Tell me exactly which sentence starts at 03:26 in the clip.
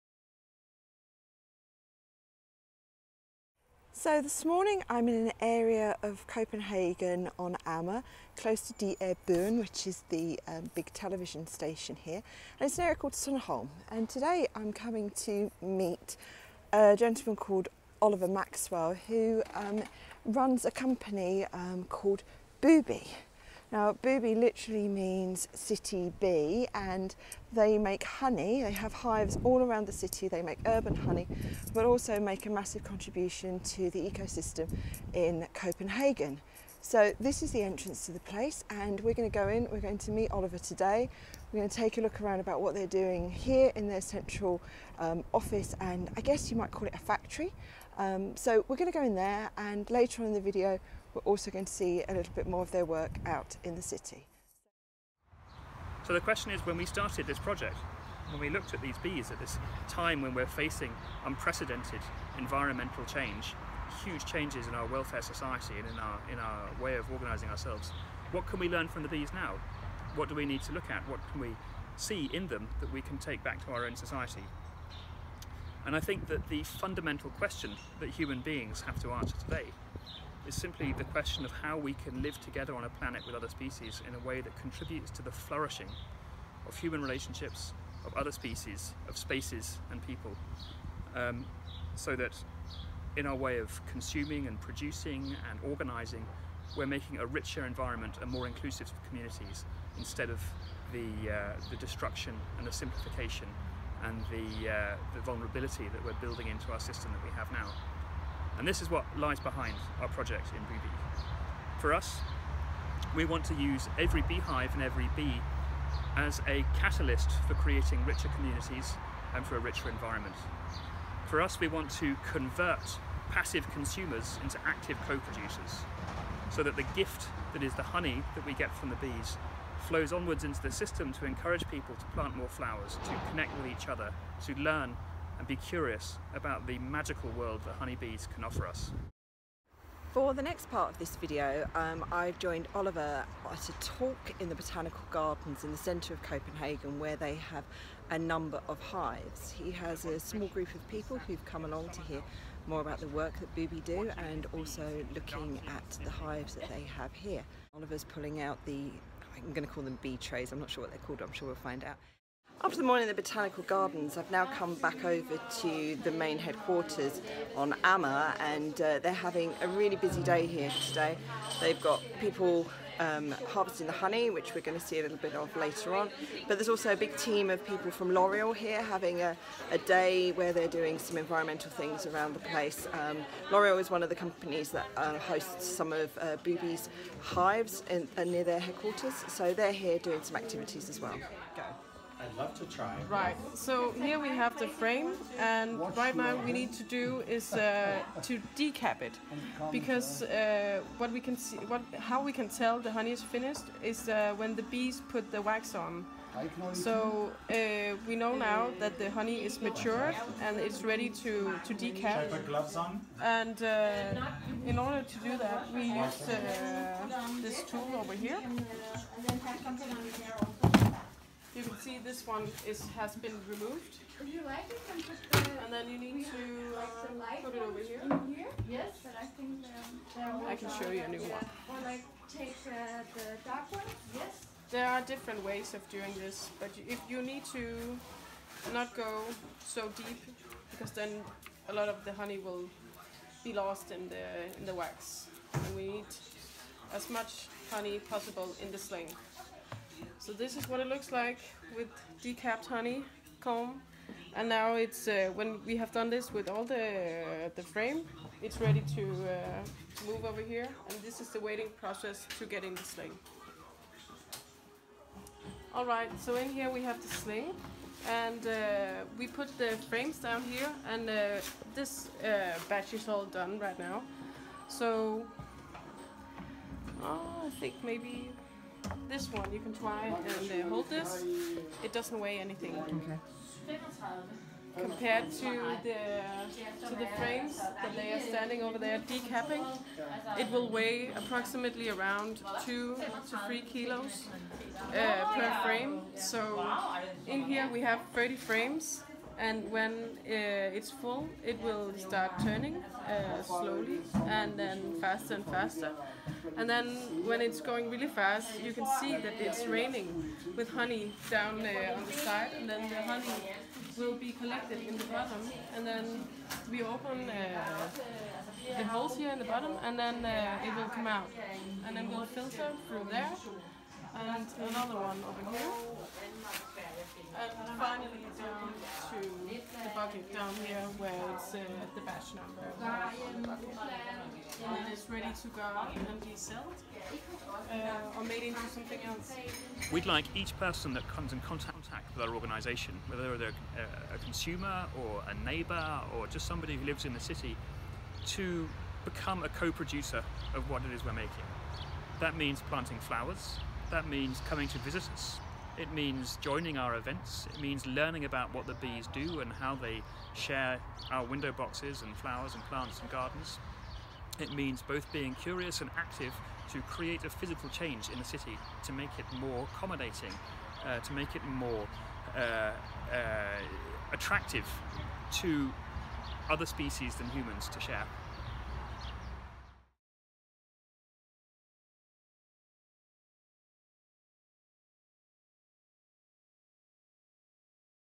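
So uh, we know now that the honey is matured and it's ready to to decap.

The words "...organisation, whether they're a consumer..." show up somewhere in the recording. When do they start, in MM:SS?
05:42.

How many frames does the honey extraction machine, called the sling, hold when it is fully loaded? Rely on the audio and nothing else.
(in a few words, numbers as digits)
30.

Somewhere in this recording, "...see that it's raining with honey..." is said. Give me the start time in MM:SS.
05:08.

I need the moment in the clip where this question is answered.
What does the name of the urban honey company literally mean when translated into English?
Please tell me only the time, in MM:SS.
00:25.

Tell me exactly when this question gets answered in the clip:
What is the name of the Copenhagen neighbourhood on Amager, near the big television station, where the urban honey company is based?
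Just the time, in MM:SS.
00:13.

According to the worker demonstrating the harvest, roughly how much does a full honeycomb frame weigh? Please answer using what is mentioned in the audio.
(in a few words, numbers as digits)
2 to 3 kilos.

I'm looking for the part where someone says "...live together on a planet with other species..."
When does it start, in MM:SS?
01:22.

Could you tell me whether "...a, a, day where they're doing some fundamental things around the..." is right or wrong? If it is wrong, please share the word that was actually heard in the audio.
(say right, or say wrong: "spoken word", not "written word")
wrong: "environmental", not "fundamental".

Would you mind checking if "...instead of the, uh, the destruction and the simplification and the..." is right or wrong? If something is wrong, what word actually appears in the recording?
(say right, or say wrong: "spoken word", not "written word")
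right.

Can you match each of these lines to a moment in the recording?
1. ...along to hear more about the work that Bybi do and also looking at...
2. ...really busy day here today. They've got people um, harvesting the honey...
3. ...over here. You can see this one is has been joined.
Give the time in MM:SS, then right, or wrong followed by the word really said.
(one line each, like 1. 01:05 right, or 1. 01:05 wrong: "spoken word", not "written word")
1. 02:31 right
2. 02:49 right
3. 03:38 wrong: "removed", not "joined".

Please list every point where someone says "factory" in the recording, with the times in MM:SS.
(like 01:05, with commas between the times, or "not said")
00:46.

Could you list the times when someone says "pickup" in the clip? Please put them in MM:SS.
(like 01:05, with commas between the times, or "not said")
not said.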